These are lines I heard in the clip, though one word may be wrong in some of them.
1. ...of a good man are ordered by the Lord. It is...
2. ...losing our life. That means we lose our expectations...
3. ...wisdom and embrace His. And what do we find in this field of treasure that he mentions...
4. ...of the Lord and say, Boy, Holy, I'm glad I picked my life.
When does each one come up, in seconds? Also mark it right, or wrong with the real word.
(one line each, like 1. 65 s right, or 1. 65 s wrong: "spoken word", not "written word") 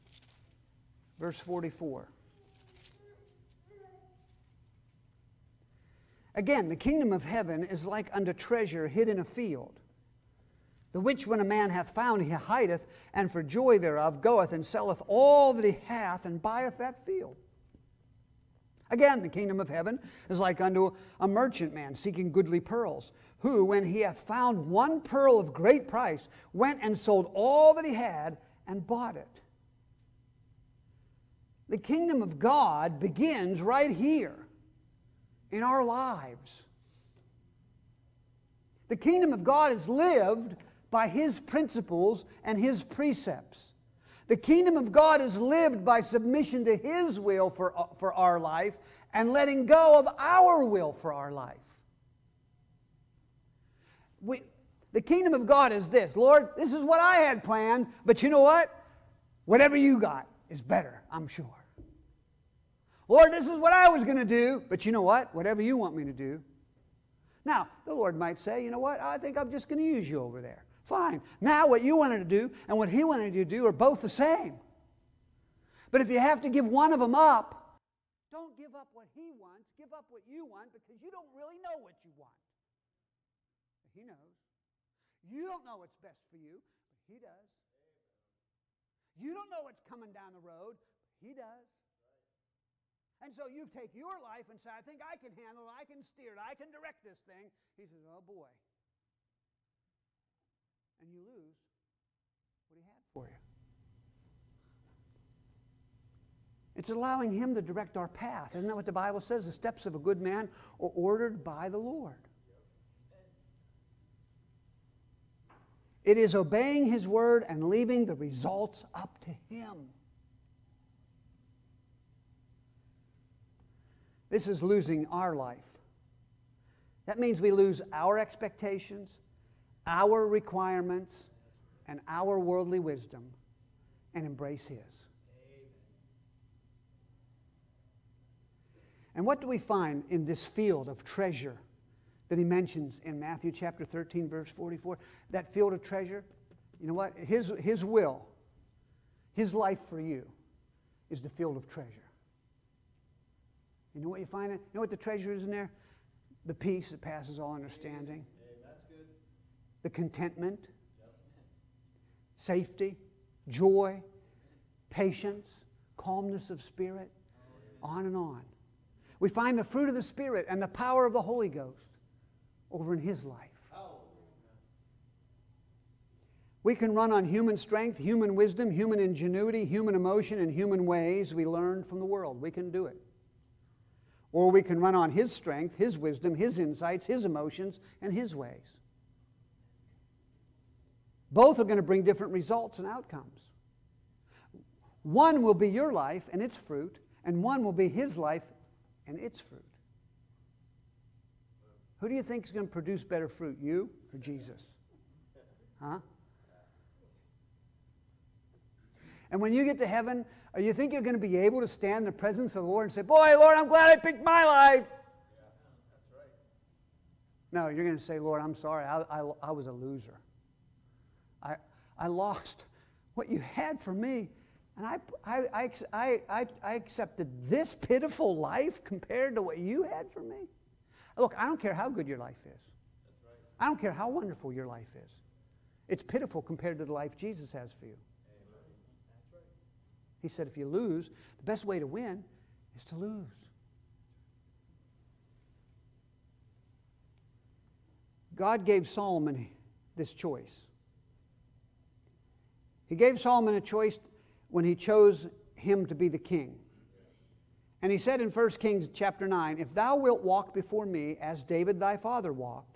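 1. 109 s right
2. 124 s right
3. 132 s right
4. 212 s wrong: "Lord", not "Holy".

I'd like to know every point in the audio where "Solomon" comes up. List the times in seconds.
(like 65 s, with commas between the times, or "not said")
248 s, 253 s.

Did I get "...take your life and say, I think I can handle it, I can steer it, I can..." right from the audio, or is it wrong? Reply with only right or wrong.
right.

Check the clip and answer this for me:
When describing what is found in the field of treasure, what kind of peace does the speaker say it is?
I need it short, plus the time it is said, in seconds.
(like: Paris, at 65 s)
Passes all understanding, at 157 s.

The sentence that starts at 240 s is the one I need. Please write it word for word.
He said, if you lose, the best way to win is to lose.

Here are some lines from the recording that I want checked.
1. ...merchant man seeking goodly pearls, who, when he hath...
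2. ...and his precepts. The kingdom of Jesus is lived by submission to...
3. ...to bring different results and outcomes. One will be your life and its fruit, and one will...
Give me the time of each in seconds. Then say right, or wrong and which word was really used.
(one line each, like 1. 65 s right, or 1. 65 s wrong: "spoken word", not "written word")
1. 21 s right
2. 42 s wrong: "God", not "Jesus"
3. 191 s right.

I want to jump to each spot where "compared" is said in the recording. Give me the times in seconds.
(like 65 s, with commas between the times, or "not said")
228 s, 236 s.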